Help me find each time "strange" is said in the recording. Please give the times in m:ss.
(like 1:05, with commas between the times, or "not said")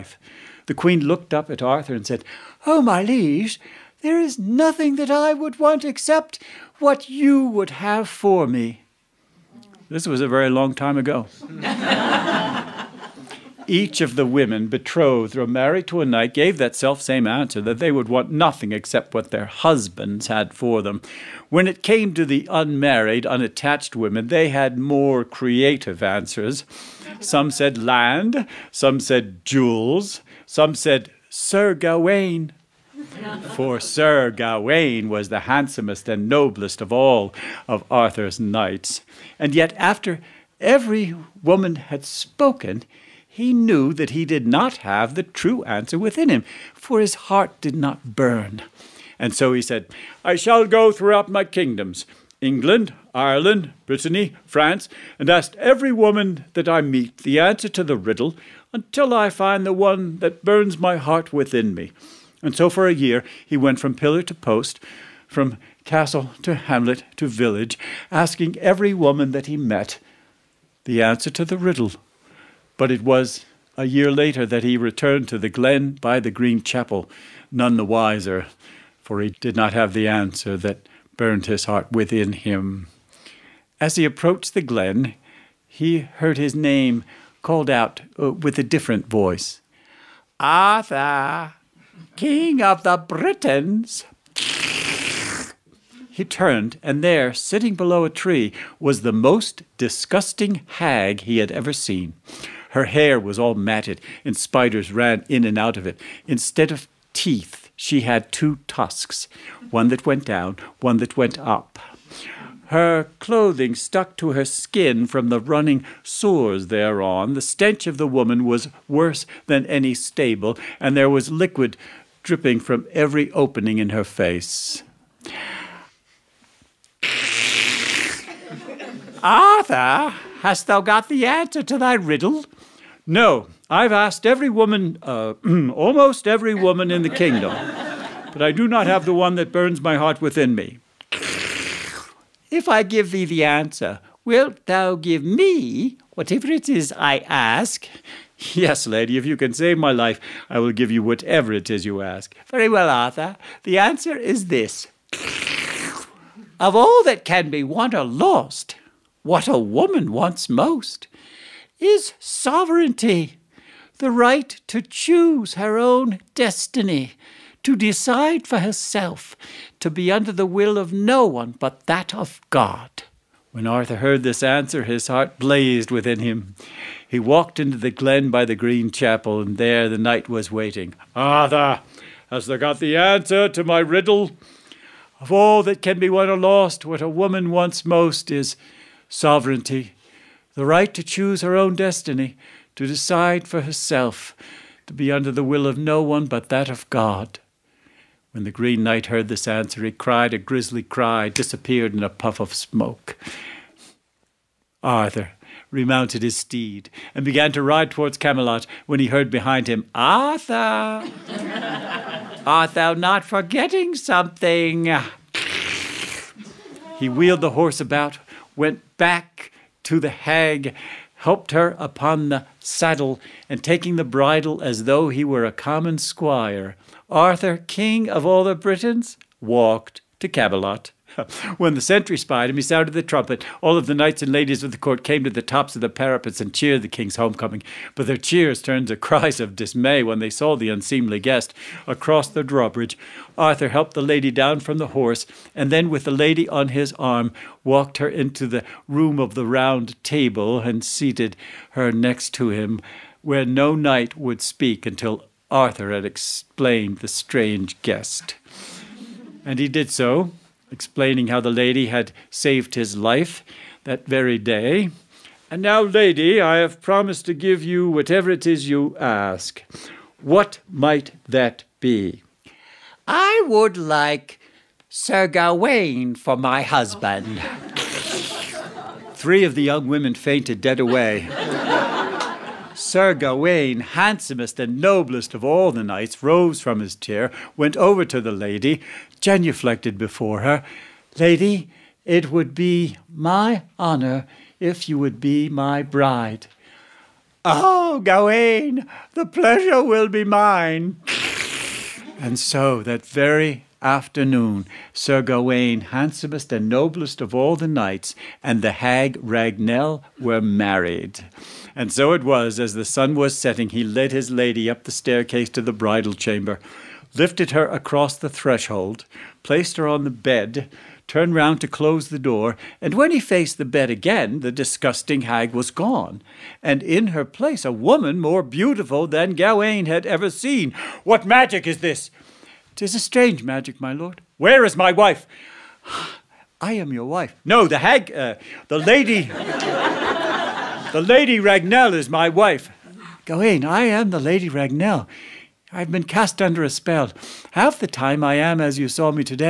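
4:17, 5:32.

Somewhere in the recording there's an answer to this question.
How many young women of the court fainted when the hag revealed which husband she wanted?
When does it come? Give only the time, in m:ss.
4:39.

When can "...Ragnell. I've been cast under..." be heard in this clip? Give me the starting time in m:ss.
5:44.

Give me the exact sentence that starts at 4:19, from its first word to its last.
And he did so, explaining how the lady had saved his life that very day.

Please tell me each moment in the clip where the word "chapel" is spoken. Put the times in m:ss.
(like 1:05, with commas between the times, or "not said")
1:16, 2:58.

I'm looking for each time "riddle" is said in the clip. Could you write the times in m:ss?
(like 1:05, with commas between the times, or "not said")
0:57, 1:11, 2:11, 3:03.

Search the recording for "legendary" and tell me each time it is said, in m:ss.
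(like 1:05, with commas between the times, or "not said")
not said.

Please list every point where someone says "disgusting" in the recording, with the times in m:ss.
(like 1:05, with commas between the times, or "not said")
1:39, 5:24.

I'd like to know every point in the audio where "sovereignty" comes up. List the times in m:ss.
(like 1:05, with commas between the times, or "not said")
2:42, 3:09.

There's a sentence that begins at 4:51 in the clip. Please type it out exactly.
Lady, it would be my honor if you would be my bride.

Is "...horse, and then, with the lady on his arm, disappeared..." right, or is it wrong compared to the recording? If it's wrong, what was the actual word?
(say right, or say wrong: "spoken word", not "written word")
wrong: "walked", not "disappeared".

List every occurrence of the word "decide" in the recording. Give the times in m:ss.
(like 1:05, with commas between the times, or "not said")
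2:47, 3:12.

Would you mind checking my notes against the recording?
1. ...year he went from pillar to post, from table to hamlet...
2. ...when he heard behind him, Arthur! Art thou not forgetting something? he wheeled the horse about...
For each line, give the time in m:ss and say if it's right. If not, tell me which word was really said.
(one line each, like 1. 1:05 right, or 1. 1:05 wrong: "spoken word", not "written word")
1. 1:02 wrong: "castle", not "table"
2. 3:28 right.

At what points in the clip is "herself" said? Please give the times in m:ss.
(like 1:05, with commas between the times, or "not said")
2:48, 3:13.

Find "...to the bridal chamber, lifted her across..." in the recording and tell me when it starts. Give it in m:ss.
5:15.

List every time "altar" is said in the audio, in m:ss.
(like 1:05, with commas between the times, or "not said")
not said.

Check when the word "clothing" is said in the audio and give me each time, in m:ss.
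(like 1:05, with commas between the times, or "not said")
1:53.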